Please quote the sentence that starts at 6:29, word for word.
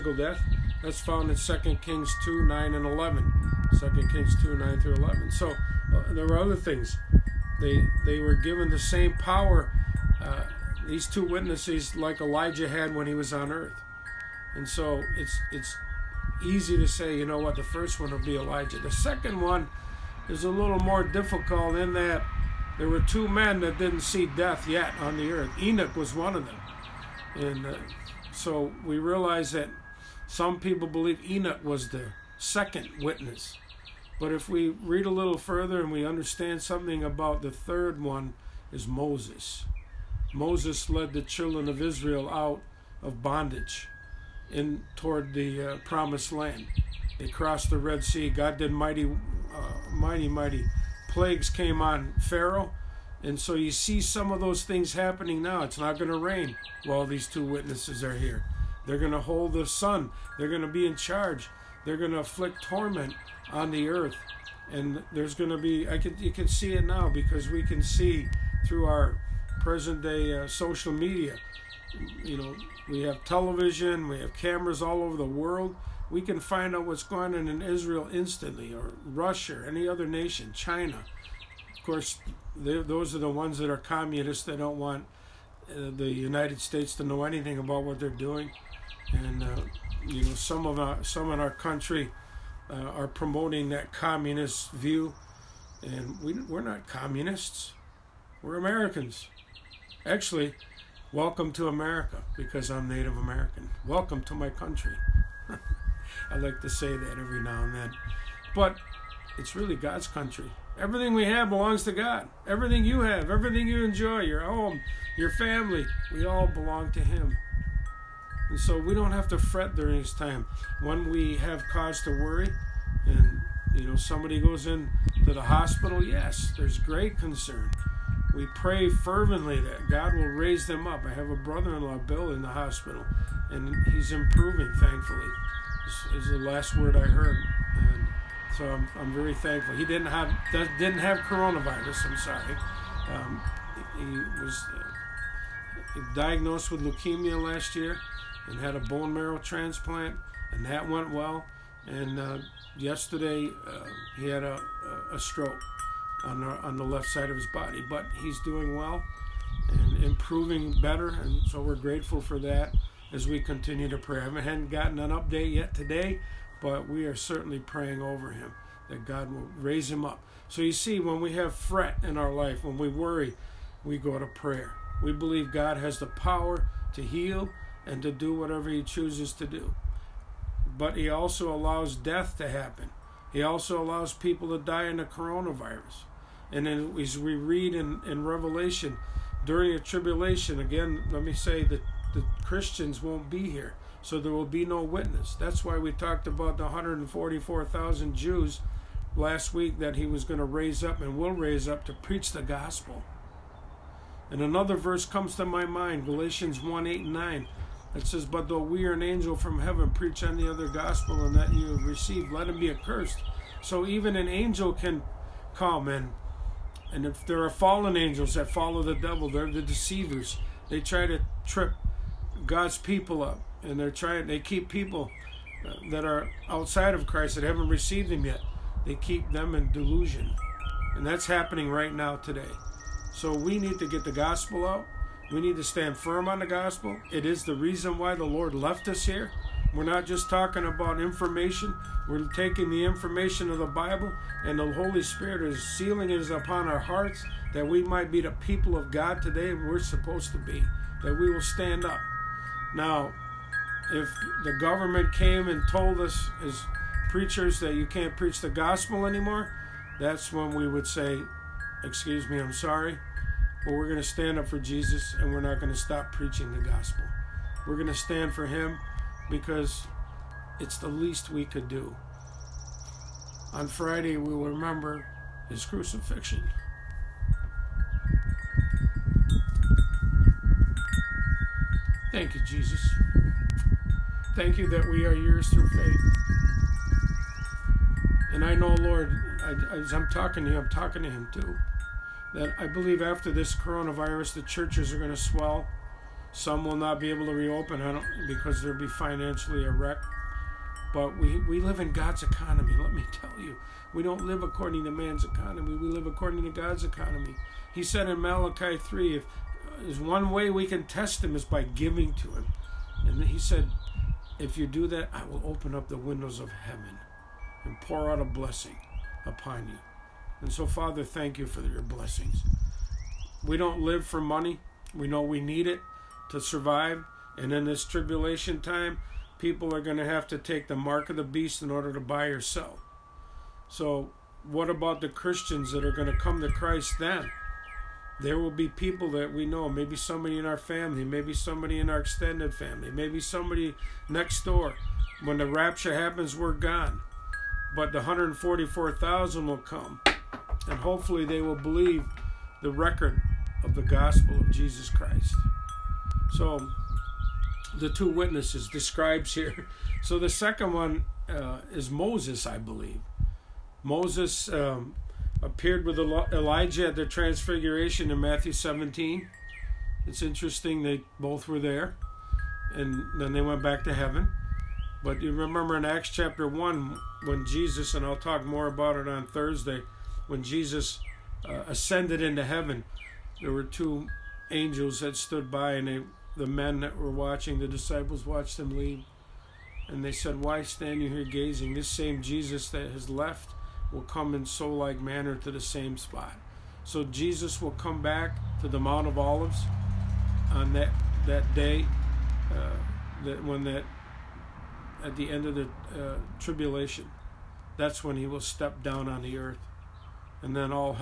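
And they said, Why stand you here gazing?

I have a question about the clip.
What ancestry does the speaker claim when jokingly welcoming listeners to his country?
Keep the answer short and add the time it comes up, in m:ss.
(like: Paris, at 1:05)
Native American, at 1:42.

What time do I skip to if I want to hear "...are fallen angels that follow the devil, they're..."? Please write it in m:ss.
3:37.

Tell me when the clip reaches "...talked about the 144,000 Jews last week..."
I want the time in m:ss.
3:15.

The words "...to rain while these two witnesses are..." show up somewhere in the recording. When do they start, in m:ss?
0:56.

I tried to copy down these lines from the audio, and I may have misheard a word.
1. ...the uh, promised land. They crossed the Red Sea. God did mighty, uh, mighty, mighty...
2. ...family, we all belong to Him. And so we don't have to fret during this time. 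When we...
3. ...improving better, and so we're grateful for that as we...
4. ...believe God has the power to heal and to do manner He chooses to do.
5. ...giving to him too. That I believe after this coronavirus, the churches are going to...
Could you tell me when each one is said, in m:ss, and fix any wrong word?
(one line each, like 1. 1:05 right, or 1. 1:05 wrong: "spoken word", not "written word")
1. 0:45 right
2. 1:55 right
3. 2:40 right
4. 2:55 wrong: "whatever", not "manner"
5. 4:50 wrong: "talking", not "giving".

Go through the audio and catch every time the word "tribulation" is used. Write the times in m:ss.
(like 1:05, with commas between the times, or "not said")
3:09, 5:27, 6:46.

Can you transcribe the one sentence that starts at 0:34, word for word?
But if we read a little further and we understand something about the third one, is Moses.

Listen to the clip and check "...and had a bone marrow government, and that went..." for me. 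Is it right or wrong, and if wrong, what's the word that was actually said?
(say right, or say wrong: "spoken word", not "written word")
wrong: "transplant", not "government".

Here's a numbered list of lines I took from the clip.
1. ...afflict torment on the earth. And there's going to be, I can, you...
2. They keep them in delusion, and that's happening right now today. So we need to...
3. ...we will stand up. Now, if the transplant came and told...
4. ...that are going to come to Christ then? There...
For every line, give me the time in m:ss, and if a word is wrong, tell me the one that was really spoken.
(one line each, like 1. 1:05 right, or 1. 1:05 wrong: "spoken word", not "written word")
1. 1:02 right
2. 3:48 right
3. 4:11 wrong: "government", not "transplant"
4. 5:35 right.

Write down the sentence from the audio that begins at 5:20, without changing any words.
And so, Father, thank you for your blessings.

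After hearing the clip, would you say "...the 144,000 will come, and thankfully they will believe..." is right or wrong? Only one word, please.
wrong.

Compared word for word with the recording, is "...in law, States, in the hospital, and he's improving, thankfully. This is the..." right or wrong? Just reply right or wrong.
wrong.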